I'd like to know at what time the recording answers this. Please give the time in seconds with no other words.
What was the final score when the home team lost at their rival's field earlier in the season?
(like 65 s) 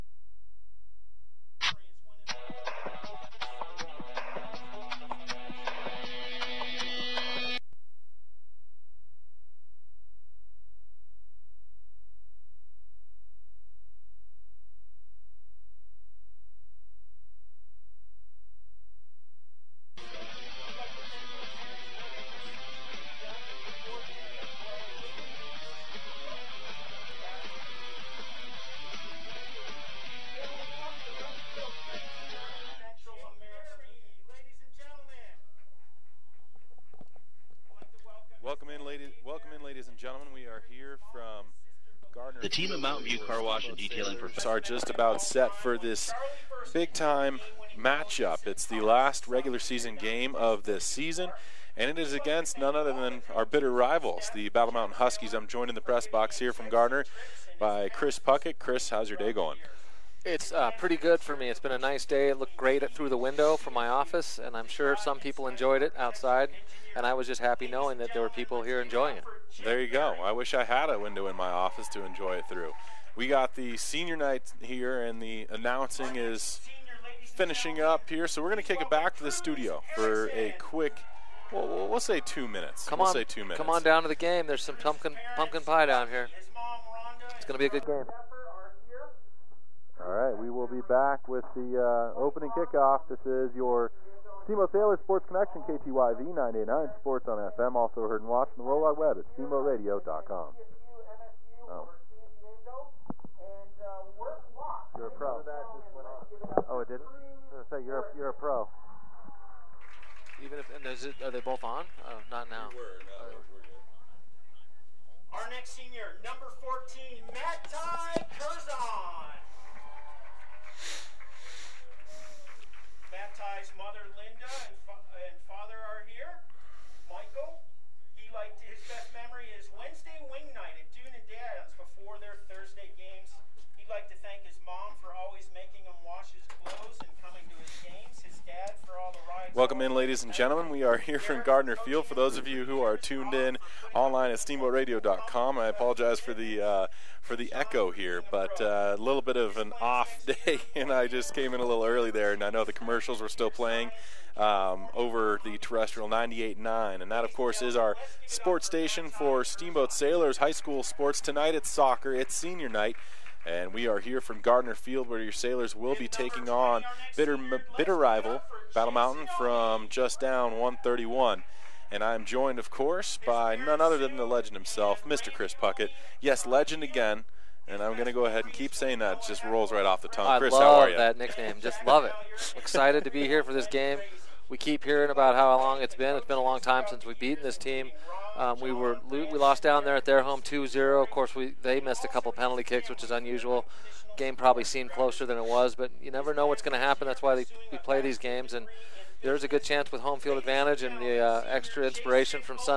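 190 s.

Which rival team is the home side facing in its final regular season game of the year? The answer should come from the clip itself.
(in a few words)
Battle Mountain Huskies.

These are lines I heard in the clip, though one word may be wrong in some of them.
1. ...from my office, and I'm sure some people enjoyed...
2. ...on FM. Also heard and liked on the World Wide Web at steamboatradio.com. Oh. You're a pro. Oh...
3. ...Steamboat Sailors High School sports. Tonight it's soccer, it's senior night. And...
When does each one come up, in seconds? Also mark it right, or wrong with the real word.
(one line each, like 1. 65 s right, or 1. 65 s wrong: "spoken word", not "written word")
1. 63 s right
2. 97 s wrong: "watched", not "liked"
3. 159 s right.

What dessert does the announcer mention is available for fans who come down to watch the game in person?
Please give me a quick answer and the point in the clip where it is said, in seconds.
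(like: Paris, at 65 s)
Pumpkin pie, at 85 s.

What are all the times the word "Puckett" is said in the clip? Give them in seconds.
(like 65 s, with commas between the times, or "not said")
58 s, 175 s.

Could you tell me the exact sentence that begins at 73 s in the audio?
We got the senior night here, and the announcing is finishing up here.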